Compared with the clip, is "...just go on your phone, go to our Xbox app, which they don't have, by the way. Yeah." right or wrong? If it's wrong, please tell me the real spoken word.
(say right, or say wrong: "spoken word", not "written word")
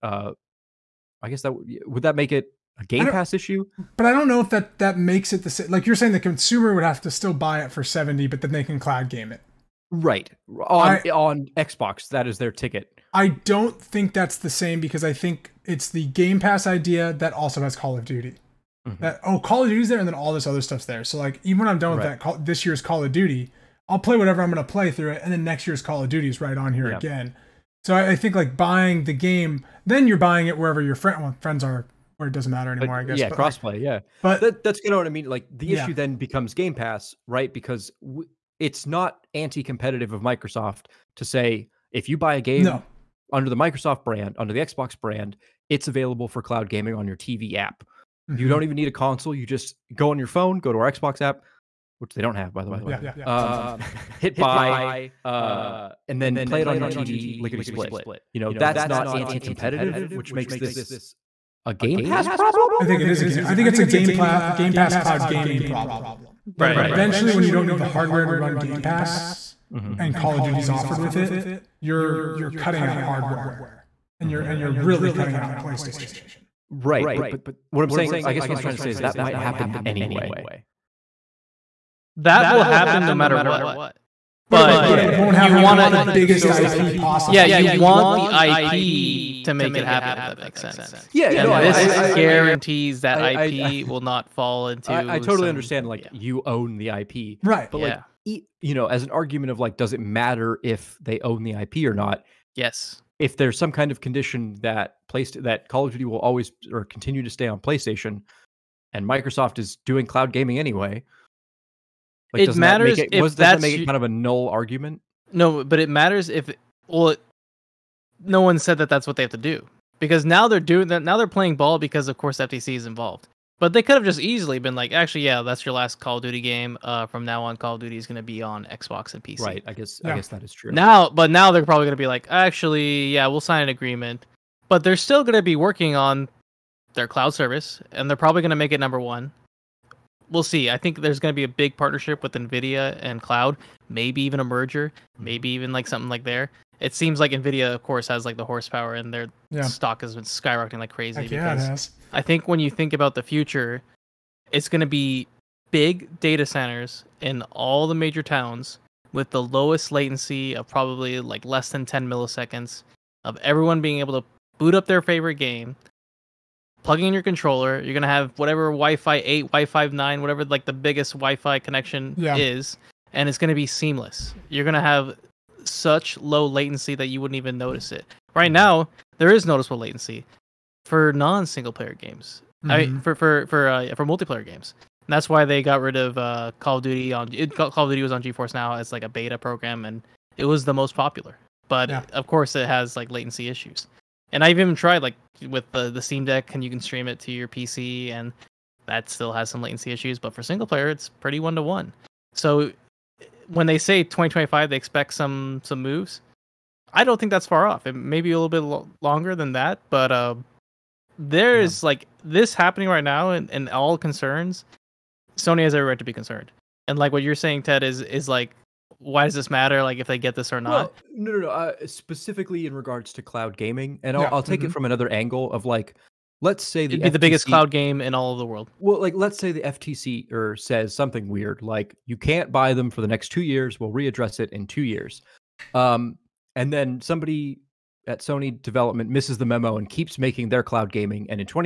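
right.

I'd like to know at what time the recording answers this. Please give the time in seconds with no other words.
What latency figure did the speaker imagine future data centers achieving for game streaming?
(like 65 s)
161 s.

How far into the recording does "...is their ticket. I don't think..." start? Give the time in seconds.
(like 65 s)
12 s.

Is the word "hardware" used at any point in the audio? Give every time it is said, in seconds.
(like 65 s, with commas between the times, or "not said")
67 s, 72 s.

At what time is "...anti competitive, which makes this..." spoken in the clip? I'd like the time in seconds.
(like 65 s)
59 s.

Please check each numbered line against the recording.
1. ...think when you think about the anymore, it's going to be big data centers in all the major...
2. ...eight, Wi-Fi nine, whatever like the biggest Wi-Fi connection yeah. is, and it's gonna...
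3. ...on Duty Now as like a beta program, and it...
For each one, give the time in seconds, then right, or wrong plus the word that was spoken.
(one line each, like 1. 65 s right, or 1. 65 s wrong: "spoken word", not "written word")
1. 152 s wrong: "future", not "anymore"
2. 169 s right
3. 188 s wrong: "GeForce", not "Duty".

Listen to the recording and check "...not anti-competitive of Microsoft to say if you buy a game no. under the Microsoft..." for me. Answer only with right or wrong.
right.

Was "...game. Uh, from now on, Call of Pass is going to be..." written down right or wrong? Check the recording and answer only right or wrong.
wrong.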